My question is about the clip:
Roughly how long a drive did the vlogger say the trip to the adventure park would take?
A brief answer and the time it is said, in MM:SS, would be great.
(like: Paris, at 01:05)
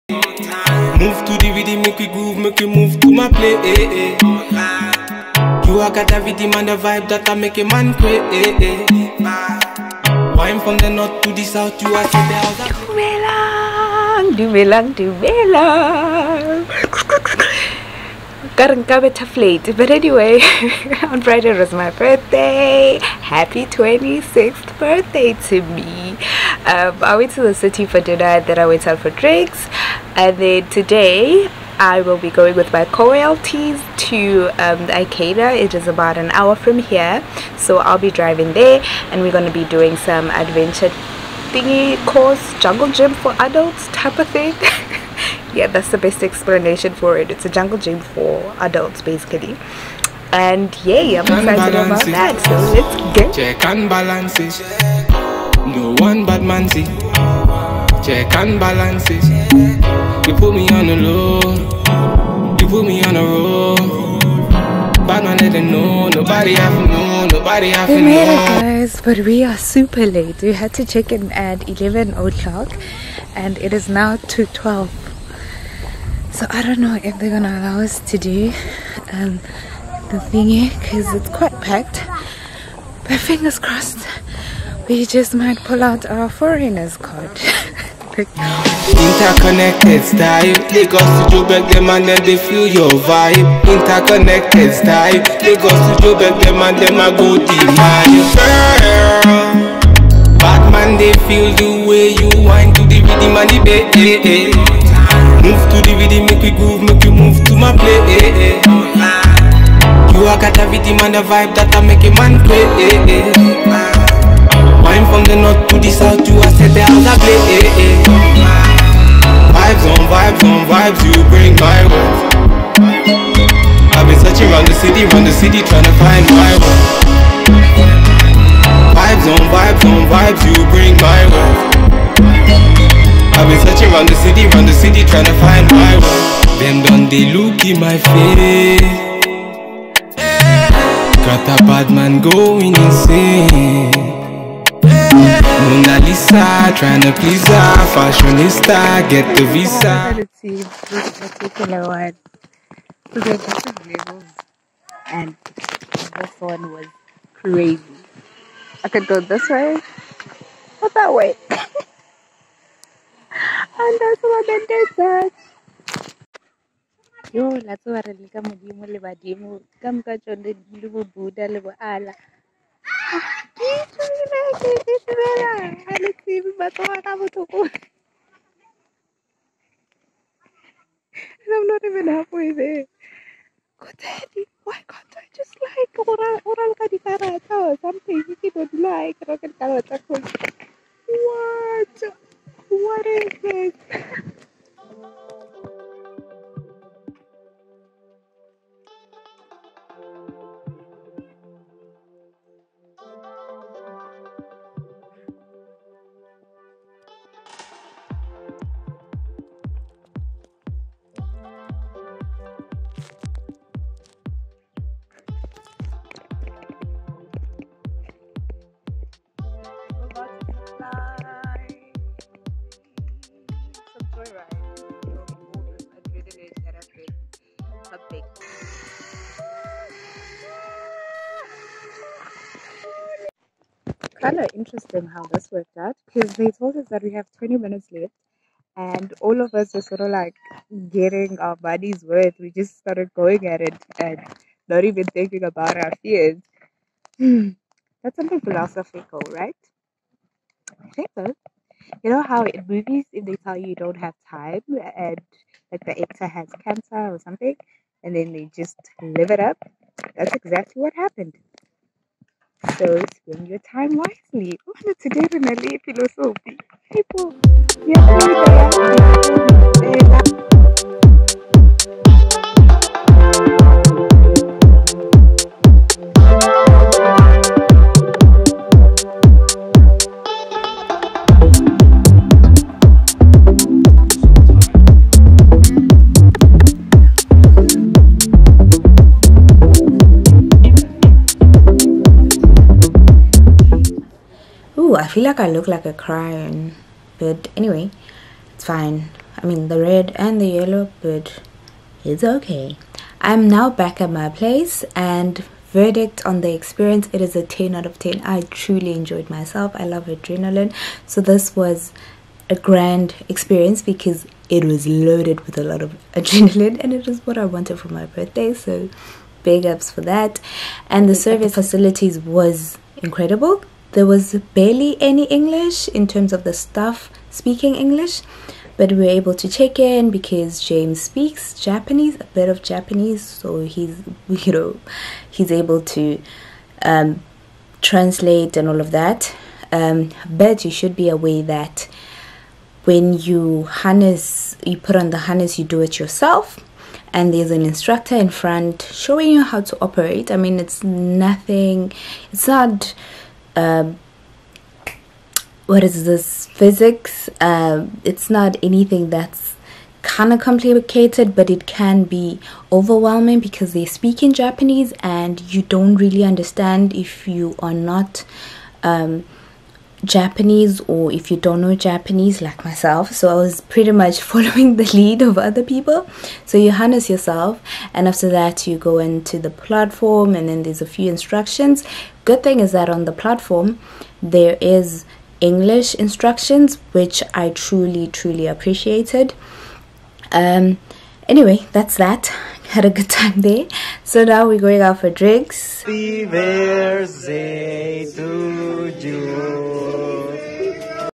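about an hour, at 00:35.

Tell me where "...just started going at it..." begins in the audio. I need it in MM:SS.
04:02.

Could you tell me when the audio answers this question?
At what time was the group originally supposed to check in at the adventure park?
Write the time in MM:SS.
01:11.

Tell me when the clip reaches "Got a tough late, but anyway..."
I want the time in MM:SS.
00:18.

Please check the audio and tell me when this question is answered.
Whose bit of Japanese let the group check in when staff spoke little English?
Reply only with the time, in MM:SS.
05:30.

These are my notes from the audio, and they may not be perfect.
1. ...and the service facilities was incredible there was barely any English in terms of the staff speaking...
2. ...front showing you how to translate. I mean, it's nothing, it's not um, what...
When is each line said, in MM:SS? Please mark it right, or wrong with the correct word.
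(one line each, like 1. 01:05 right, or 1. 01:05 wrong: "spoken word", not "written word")
1. 05:20 right
2. 05:48 wrong: "operate", not "translate".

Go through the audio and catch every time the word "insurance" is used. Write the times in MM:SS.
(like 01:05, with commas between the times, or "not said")
not said.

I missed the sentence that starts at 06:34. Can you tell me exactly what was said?
So now we're going out for drinks.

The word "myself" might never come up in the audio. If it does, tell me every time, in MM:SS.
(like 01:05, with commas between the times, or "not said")
05:09, 06:12.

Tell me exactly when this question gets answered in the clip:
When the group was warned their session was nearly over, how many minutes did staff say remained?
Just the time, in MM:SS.
03:57.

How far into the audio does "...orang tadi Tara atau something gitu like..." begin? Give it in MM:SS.
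03:06.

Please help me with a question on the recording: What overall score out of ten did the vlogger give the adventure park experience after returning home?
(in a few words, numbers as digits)
10 out of 10.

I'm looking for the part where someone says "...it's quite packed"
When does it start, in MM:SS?
01:21.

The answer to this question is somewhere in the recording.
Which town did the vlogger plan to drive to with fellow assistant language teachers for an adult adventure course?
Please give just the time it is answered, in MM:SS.
00:34.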